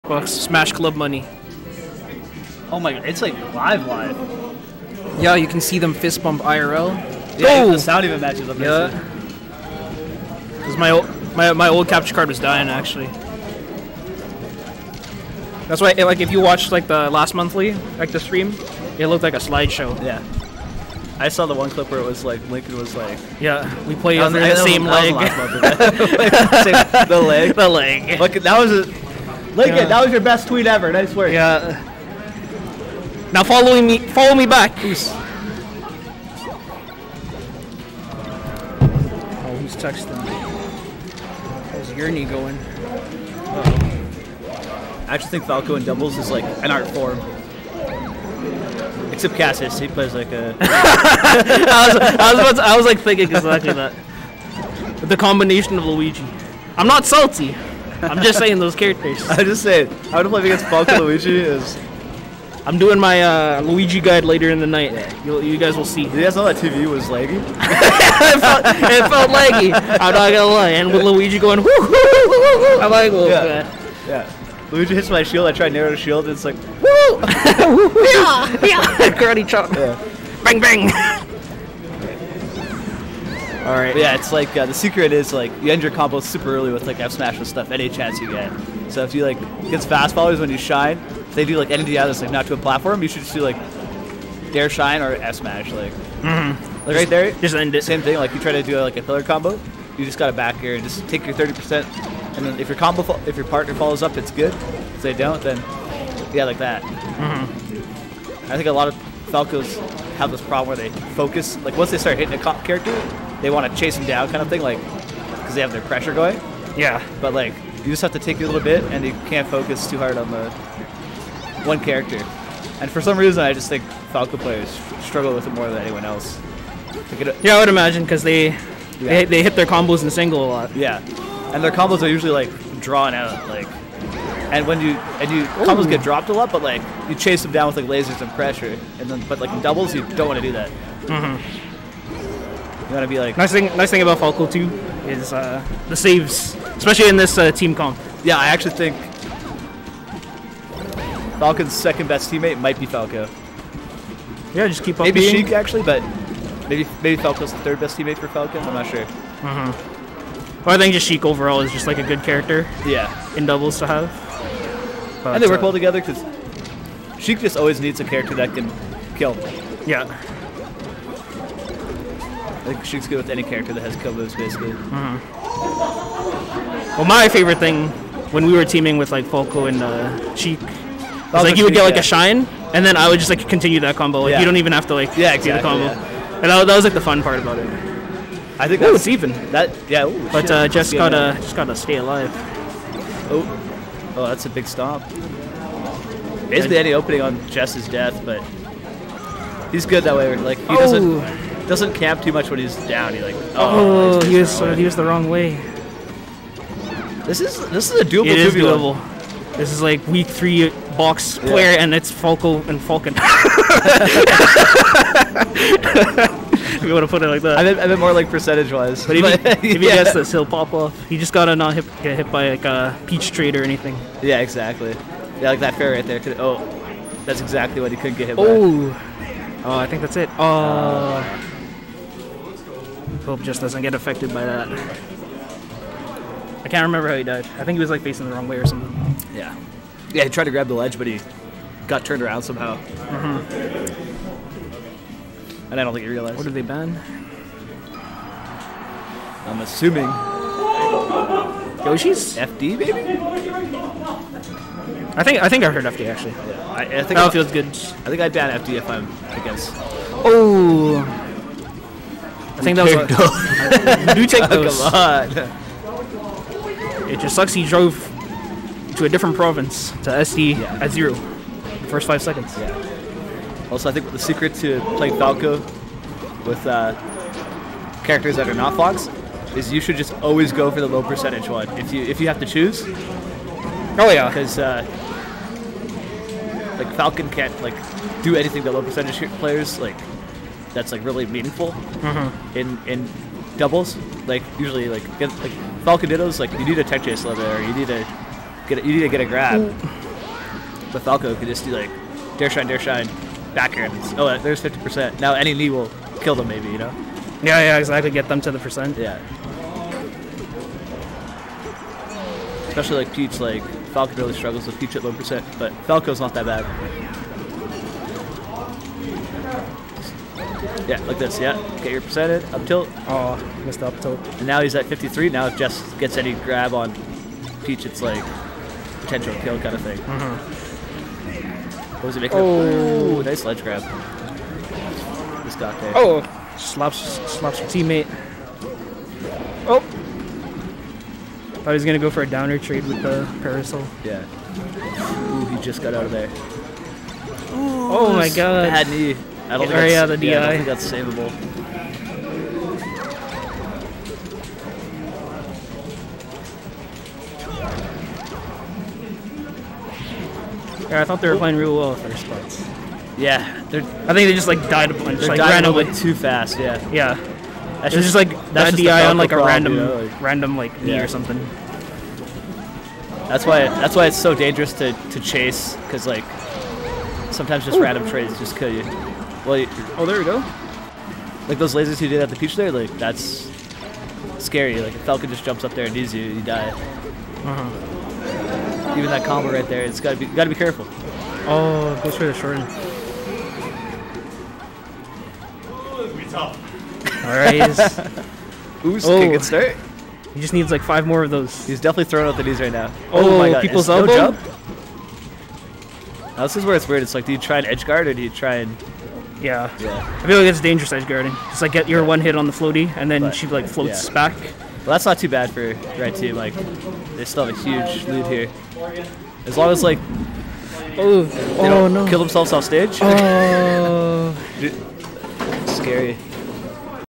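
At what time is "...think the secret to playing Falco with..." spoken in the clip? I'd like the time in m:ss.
4:33.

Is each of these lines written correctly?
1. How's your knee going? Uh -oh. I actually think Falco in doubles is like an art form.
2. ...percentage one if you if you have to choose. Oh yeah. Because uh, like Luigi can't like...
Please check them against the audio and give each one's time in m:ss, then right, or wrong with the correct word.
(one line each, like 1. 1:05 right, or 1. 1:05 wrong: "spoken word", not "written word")
1. 0:41 right
2. 4:41 wrong: "Falcon", not "Luigi".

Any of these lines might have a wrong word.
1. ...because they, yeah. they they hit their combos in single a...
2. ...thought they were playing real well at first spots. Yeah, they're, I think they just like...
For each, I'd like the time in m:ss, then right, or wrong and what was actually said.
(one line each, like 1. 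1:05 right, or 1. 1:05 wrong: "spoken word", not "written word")
1. 2:08 right
2. 6:01 right.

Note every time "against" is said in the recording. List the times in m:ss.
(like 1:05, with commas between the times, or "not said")
1:00, 4:19.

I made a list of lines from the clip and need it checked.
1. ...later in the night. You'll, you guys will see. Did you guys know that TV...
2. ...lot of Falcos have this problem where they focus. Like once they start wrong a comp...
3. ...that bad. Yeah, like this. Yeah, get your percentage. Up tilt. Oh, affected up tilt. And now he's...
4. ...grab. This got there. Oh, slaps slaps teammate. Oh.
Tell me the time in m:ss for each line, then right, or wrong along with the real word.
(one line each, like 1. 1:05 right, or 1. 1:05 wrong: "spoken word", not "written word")
1. 1:04 right
2. 1:48 wrong: "hitting", not "wrong"
3. 5:16 wrong: "missed", not "affected"
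4. 5:33 right.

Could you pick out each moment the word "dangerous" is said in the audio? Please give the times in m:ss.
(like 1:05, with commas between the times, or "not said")
6:14, 6:50.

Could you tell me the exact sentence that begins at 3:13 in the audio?
Oh, oh, that's a big stop.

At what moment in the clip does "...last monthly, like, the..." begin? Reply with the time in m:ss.
0:17.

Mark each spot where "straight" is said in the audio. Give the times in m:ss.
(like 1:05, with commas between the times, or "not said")
6:32.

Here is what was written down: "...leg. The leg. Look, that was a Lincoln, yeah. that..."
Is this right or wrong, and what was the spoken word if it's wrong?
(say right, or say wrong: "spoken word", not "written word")
right.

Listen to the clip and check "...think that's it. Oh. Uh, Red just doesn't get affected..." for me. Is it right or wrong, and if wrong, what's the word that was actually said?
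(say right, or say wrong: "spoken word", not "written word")
wrong: "Pope", not "Red".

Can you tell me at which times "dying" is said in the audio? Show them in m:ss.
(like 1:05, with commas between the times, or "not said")
0:12.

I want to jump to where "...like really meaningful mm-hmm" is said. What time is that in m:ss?
4:50.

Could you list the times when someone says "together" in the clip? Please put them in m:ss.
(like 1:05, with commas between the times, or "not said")
2:45.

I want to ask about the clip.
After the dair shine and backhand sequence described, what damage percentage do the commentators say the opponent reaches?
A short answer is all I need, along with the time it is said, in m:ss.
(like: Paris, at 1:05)
50%, at 5:04.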